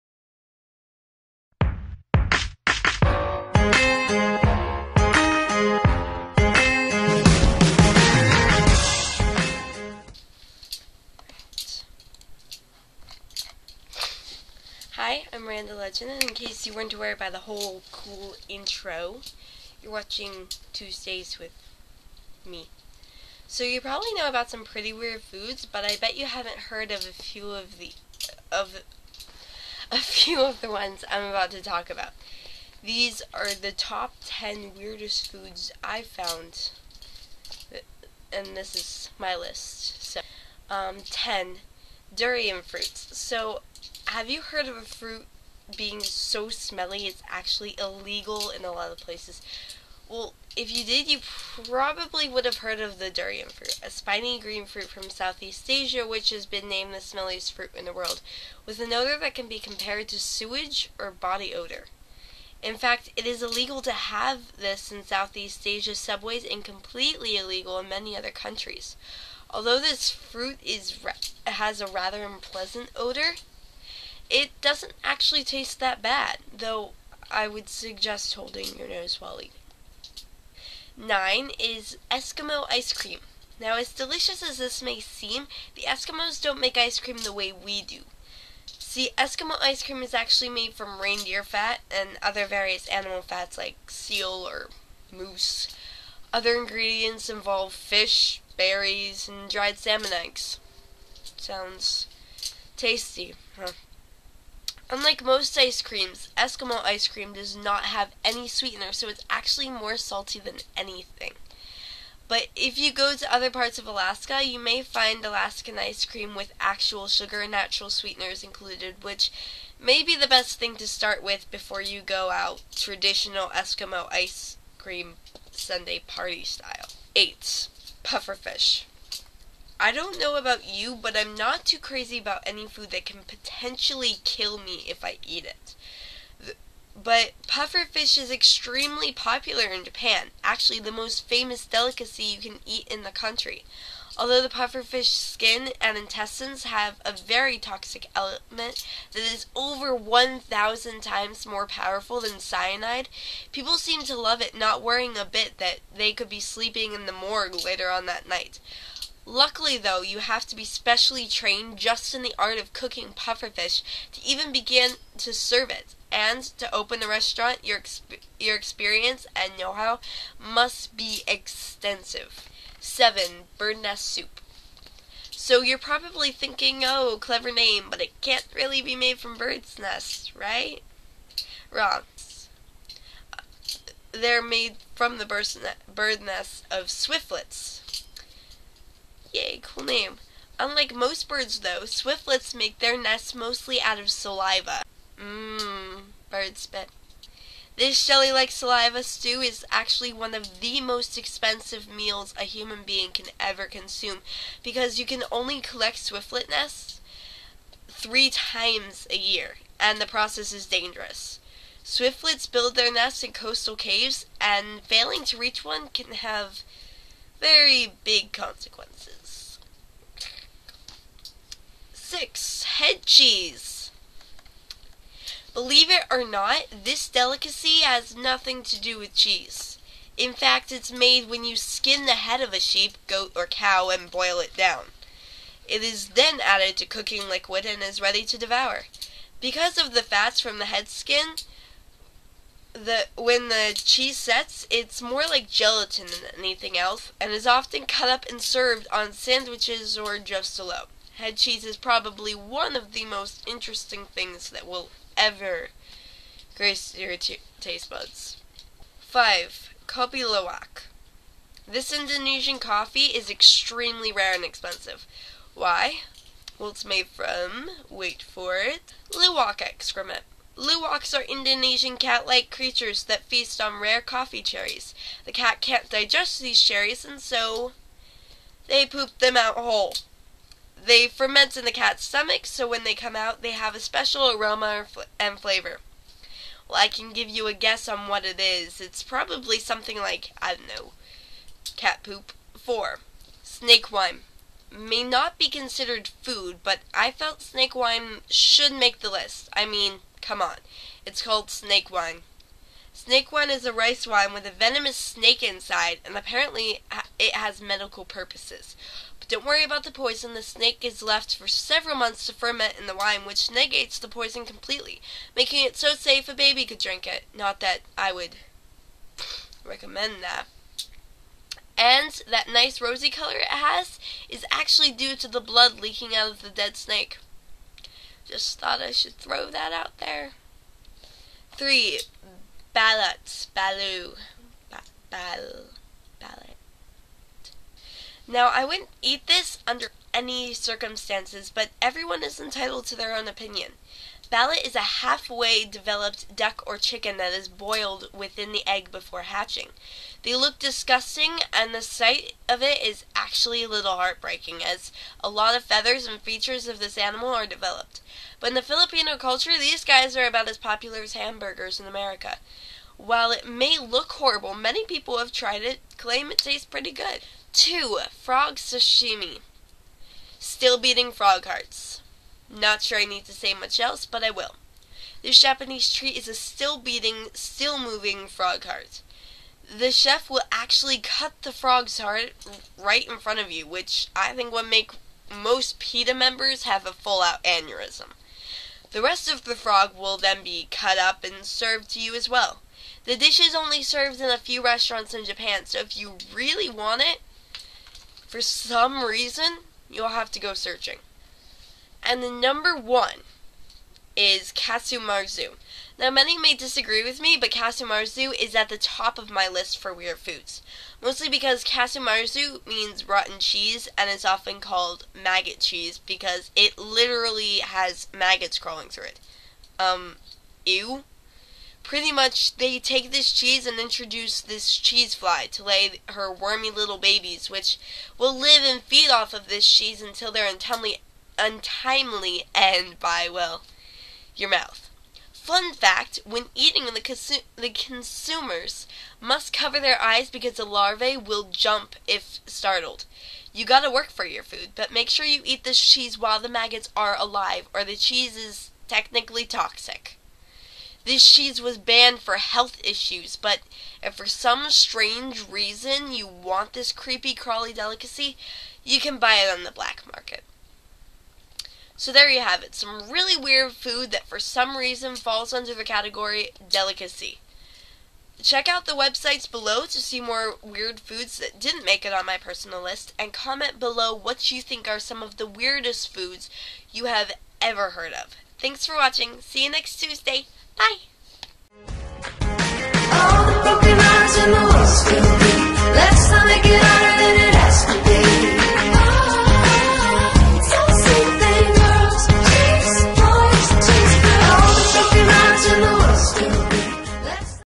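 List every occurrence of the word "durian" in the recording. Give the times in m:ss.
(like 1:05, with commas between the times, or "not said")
0:42, 0:53.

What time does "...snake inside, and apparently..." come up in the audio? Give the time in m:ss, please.
5:04.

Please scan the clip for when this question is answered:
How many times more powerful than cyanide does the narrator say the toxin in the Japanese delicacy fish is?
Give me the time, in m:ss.
2:29.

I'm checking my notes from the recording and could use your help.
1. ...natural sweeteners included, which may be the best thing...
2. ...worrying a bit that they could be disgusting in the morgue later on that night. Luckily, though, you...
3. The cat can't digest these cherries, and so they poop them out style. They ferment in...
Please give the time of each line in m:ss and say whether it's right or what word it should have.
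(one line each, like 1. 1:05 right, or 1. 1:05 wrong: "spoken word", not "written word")
1. 1:57 right
2. 2:34 wrong: "sleeping", not "disgusting"
3. 4:35 wrong: "whole", not "style".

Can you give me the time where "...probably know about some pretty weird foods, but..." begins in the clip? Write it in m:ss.
0:23.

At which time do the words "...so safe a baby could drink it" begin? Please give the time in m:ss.
5:15.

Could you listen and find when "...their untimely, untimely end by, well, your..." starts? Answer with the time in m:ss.
7:10.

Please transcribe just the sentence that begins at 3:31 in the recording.
Swiftlets build their nests in coastal caves, and failing to reach one can have very big consequences.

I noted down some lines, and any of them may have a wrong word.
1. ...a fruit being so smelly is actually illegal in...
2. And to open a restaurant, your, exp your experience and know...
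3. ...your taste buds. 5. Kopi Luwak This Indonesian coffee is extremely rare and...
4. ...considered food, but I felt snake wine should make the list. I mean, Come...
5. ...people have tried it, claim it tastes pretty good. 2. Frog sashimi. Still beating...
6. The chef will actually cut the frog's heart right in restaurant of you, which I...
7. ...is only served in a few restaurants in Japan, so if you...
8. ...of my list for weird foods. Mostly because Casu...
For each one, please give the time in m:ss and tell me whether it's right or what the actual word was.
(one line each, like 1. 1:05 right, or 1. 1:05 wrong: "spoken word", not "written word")
1. 0:44 right
2. 2:46 right
3. 4:16 right
4. 4:55 right
5. 6:04 right
6. 6:19 wrong: "front", not "restaurant"
7. 6:33 right
8. 6:49 right.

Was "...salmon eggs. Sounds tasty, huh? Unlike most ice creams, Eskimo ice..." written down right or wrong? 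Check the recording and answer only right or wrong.
right.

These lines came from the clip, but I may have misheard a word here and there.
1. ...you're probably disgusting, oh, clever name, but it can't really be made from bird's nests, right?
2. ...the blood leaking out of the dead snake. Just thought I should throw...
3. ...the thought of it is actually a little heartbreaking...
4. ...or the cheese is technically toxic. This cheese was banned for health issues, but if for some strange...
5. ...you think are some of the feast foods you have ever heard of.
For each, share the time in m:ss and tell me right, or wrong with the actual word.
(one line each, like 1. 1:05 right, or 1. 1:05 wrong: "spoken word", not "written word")
1. 2:55 wrong: "thinking", not "disgusting"
2. 5:25 right
3. 5:51 wrong: "sight", not "thought"
4. 7:27 right
5. 7:54 wrong: "weirdest", not "feast".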